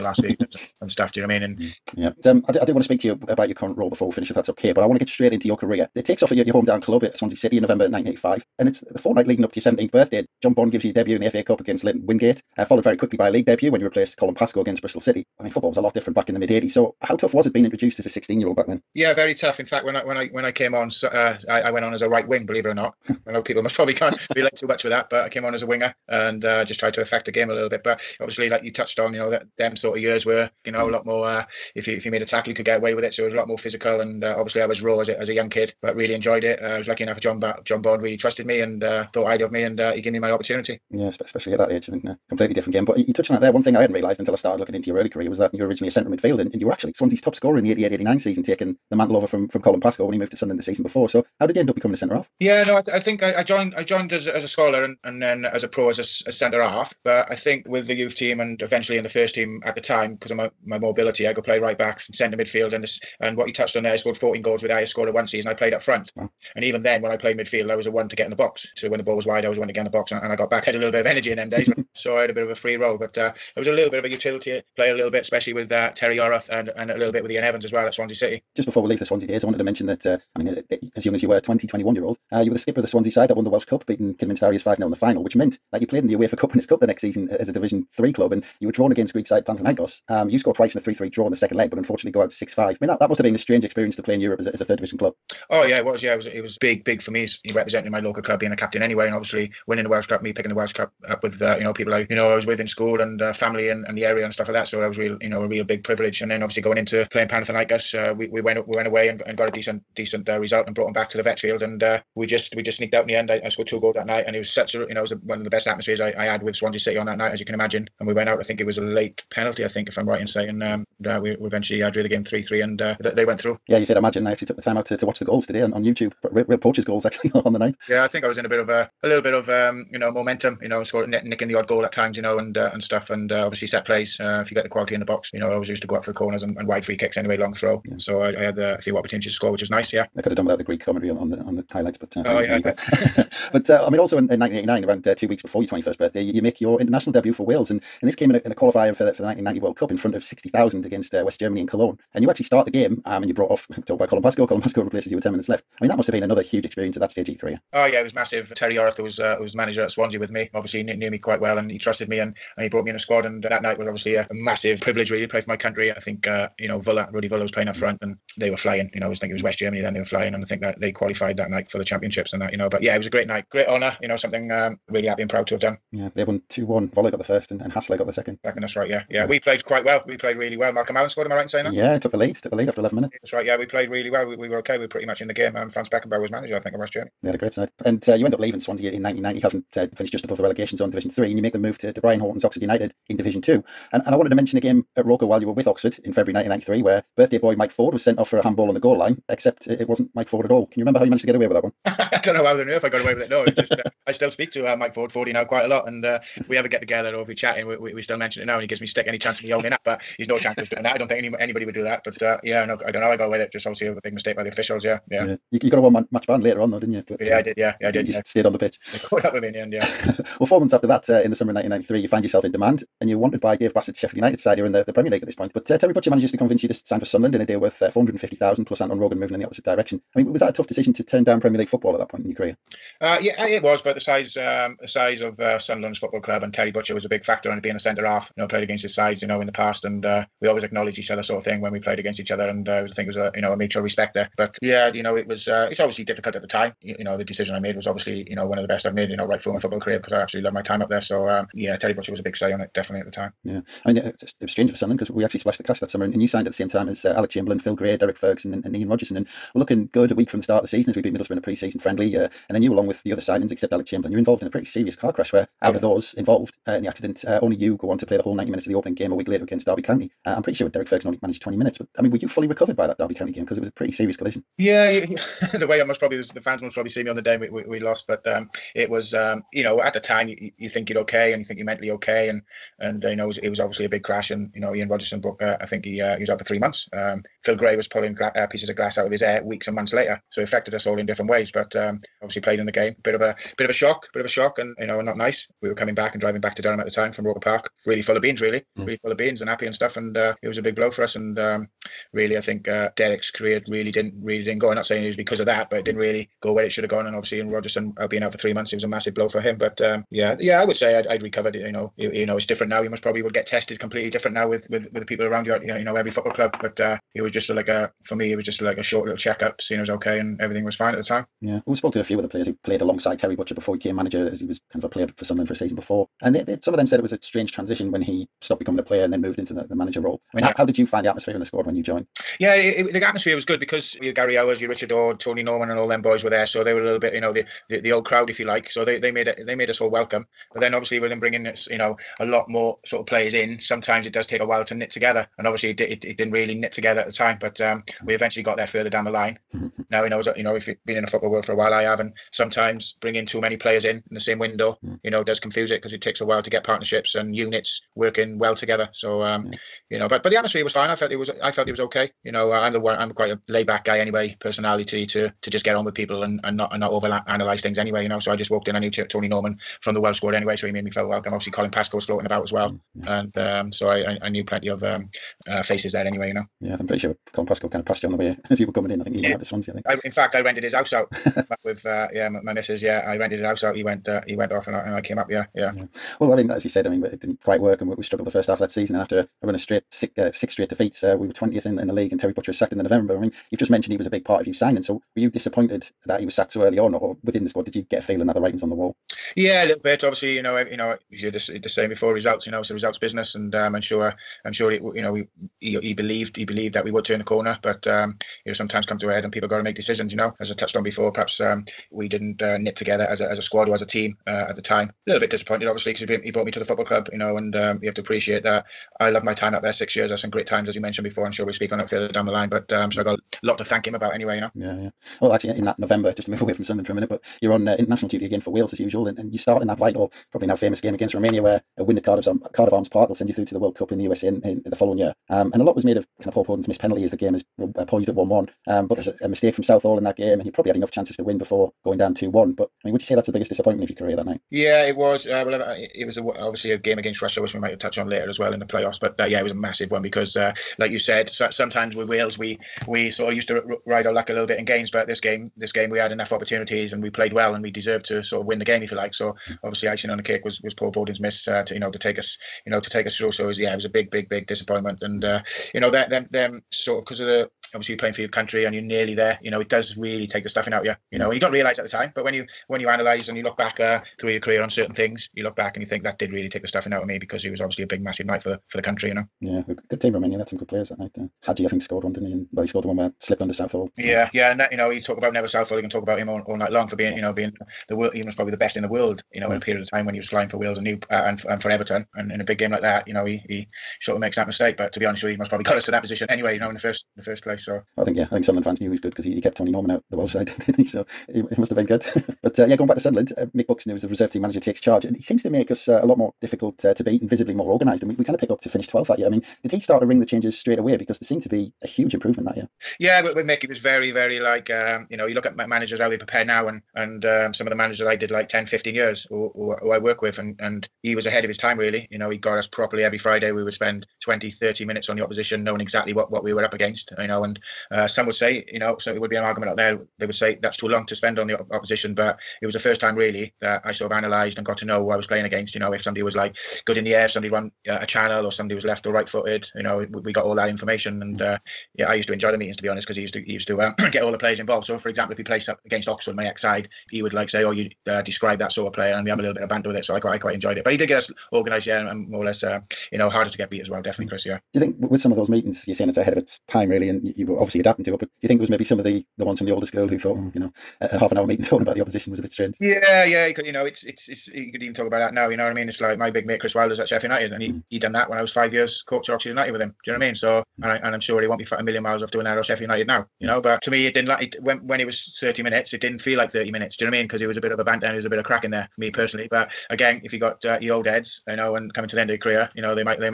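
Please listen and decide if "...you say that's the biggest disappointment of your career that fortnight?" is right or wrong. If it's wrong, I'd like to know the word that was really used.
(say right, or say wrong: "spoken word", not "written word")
wrong: "night", not "fortnight".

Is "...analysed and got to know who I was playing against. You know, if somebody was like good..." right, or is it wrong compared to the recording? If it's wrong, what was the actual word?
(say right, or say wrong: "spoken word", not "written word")
right.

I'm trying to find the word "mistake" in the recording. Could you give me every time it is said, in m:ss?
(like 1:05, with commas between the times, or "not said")
3:34, 7:19, 8:14.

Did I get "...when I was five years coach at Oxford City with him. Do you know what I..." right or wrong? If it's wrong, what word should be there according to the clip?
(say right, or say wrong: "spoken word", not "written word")
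wrong: "United", not "City".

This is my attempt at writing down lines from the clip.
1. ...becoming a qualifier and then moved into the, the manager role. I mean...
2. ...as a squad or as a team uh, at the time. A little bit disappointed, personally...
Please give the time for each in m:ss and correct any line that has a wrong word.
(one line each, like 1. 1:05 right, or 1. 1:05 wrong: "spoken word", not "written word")
1. 5:28 wrong: "player", not "qualifier"
2. 6:53 wrong: "obviously", not "personally".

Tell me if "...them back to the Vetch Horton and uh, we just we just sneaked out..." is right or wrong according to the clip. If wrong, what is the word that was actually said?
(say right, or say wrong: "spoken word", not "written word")
wrong: "Field", not "Horton".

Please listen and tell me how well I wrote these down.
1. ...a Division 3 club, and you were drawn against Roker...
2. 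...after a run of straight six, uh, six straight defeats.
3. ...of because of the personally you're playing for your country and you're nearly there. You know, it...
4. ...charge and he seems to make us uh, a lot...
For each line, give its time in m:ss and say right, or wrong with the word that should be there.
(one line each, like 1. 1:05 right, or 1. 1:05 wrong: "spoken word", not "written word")
1. 1:27 wrong: "Greek", not "Roker"
2. 6:29 right
3. 7:47 wrong: "obviously", not "personally"
4. 8:24 right.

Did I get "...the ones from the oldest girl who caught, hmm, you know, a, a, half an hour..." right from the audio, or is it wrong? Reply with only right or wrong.
wrong.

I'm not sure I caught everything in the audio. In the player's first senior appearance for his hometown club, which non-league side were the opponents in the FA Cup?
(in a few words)
Leyton Wingate.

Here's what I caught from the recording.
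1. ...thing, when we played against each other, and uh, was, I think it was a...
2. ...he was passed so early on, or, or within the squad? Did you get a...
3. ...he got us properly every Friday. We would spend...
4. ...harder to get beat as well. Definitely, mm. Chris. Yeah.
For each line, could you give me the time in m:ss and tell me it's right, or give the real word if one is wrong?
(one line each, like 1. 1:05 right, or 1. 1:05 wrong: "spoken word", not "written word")
1. 4:01 right
2. 6:36 wrong: "sacked", not "passed"
3. 8:42 right
4. 9:13 right.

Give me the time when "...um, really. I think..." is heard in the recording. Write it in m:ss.
5:01.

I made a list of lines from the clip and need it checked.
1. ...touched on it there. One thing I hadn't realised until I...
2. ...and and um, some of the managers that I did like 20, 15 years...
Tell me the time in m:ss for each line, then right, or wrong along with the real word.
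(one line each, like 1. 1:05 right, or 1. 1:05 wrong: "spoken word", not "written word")
1. 0:43 right
2. 8:36 wrong: "10", not "20".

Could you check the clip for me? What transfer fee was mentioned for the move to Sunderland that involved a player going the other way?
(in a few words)
450,000.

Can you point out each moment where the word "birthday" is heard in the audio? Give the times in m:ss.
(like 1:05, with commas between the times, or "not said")
0:09, 2:25, 3:17.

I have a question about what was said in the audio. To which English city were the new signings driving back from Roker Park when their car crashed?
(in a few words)
Durham.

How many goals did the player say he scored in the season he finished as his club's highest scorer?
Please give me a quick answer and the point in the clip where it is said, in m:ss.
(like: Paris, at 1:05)
14, at 1:04.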